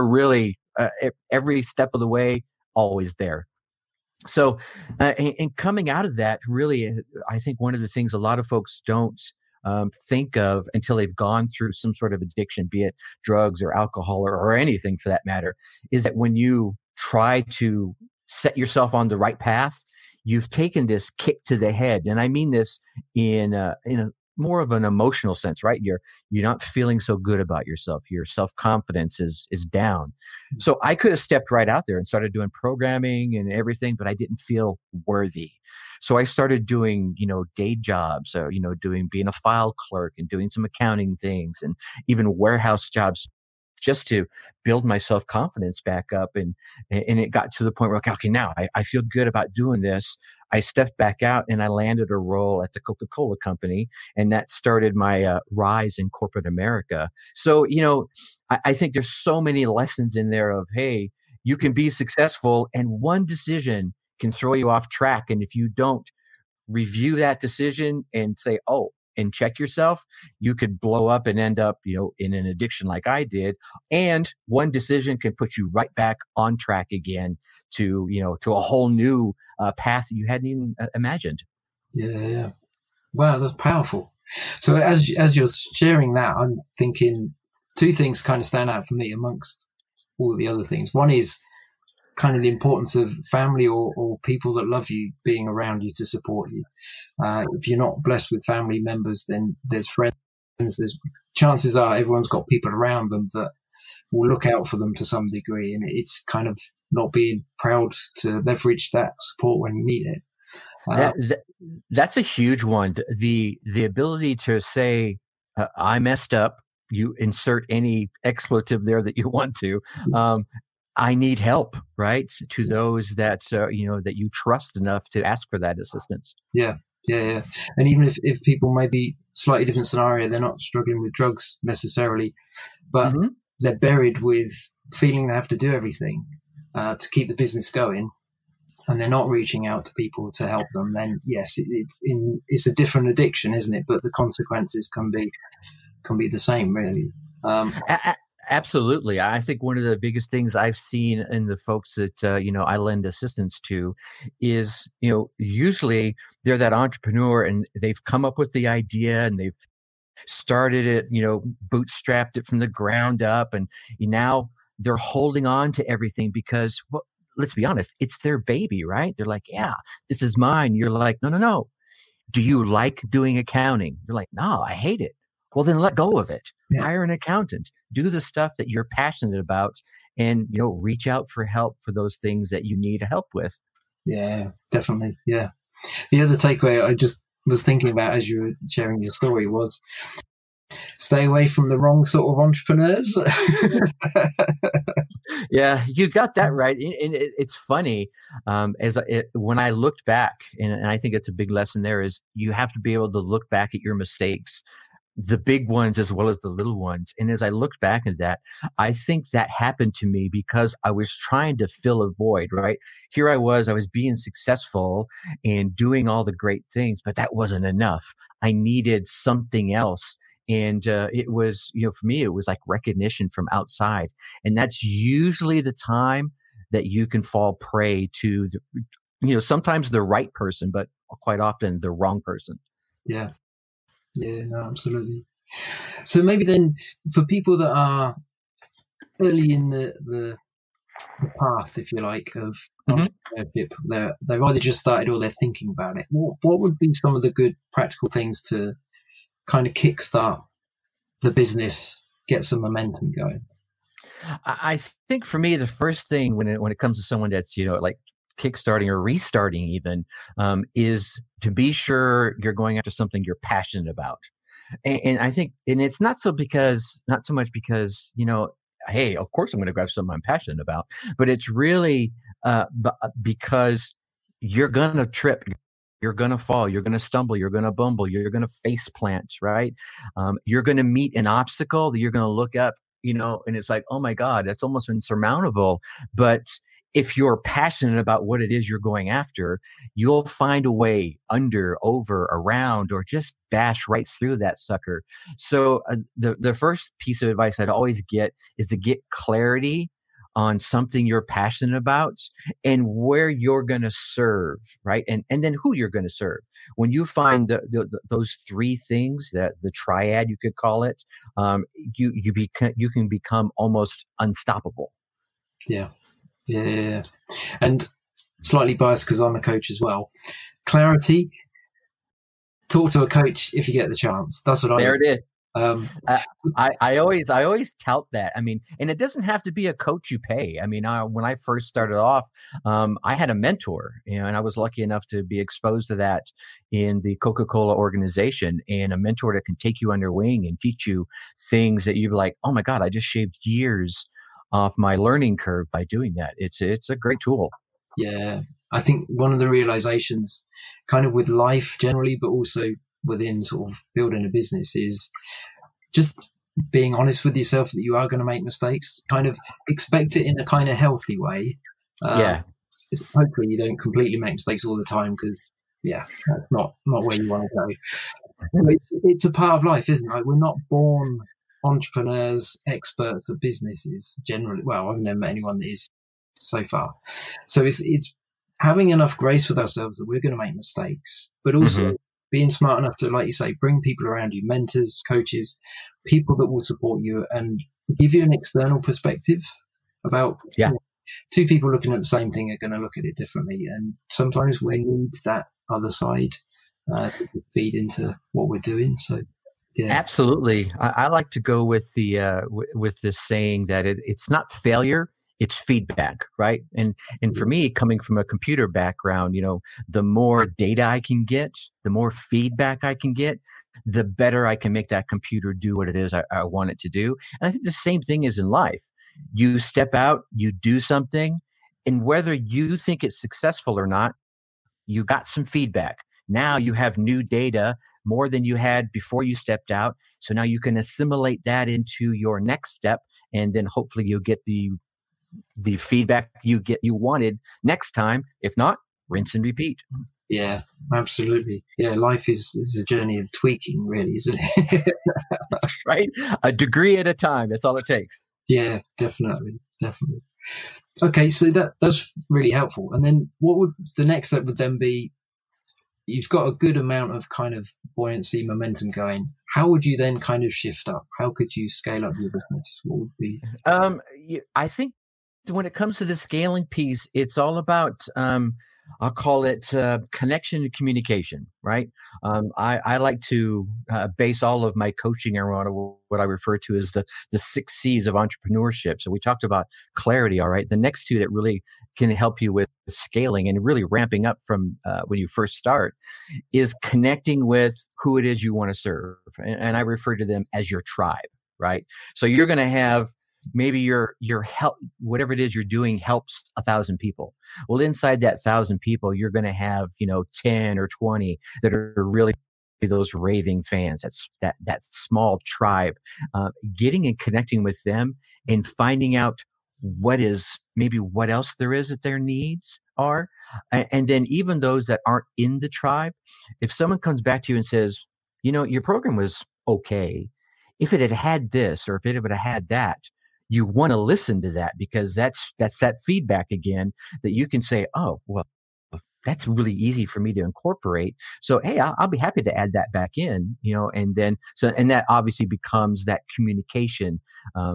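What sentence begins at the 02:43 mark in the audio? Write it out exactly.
And now they're holding on to everything because, well, let's be honest, it's their baby, right?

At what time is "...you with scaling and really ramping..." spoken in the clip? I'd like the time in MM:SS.
08:02.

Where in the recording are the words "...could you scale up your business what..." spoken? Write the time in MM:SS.
07:41.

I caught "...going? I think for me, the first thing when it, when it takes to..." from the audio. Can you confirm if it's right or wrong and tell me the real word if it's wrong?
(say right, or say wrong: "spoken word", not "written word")
wrong: "comes", not "takes".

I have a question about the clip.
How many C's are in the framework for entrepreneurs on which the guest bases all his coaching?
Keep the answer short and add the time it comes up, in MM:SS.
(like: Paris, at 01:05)
6, at 07:57.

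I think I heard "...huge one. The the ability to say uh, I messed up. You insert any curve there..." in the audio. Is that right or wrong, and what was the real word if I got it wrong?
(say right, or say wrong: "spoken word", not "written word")
wrong: "expletive", not "curve".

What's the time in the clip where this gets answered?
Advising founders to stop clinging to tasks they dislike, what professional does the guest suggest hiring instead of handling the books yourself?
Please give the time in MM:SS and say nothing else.
02:57.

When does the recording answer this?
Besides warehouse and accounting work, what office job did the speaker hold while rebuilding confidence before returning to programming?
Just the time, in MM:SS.
00:39.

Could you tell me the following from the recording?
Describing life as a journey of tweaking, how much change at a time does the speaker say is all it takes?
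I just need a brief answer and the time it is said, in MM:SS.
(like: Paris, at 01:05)
a degree, at 07:26.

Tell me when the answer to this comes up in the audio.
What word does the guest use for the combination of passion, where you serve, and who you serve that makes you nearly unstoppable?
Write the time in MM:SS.
05:09.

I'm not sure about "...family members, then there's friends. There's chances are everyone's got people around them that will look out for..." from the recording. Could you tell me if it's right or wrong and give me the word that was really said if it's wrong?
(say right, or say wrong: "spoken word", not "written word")
right.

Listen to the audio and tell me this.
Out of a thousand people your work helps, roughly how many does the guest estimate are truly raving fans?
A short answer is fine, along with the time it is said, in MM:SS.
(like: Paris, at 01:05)
10 or 20, at 08:20.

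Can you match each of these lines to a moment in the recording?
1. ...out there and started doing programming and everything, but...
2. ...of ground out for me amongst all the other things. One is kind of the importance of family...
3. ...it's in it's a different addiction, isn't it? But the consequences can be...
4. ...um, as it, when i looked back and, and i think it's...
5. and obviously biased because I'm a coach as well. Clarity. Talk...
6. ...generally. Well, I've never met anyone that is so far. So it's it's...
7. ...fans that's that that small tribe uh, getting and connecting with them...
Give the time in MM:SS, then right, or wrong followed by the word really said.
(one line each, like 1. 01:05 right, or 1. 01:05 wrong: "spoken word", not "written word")
1. 00:31 right
2. 01:28 wrong: "stand", not "ground"
3. 02:21 right
4. 03:18 right
5. 05:17 wrong: "slightly", not "obviously"
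6. 06:14 right
7. 08:23 right.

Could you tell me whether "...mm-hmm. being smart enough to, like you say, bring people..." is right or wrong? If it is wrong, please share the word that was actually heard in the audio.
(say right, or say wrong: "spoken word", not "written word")
right.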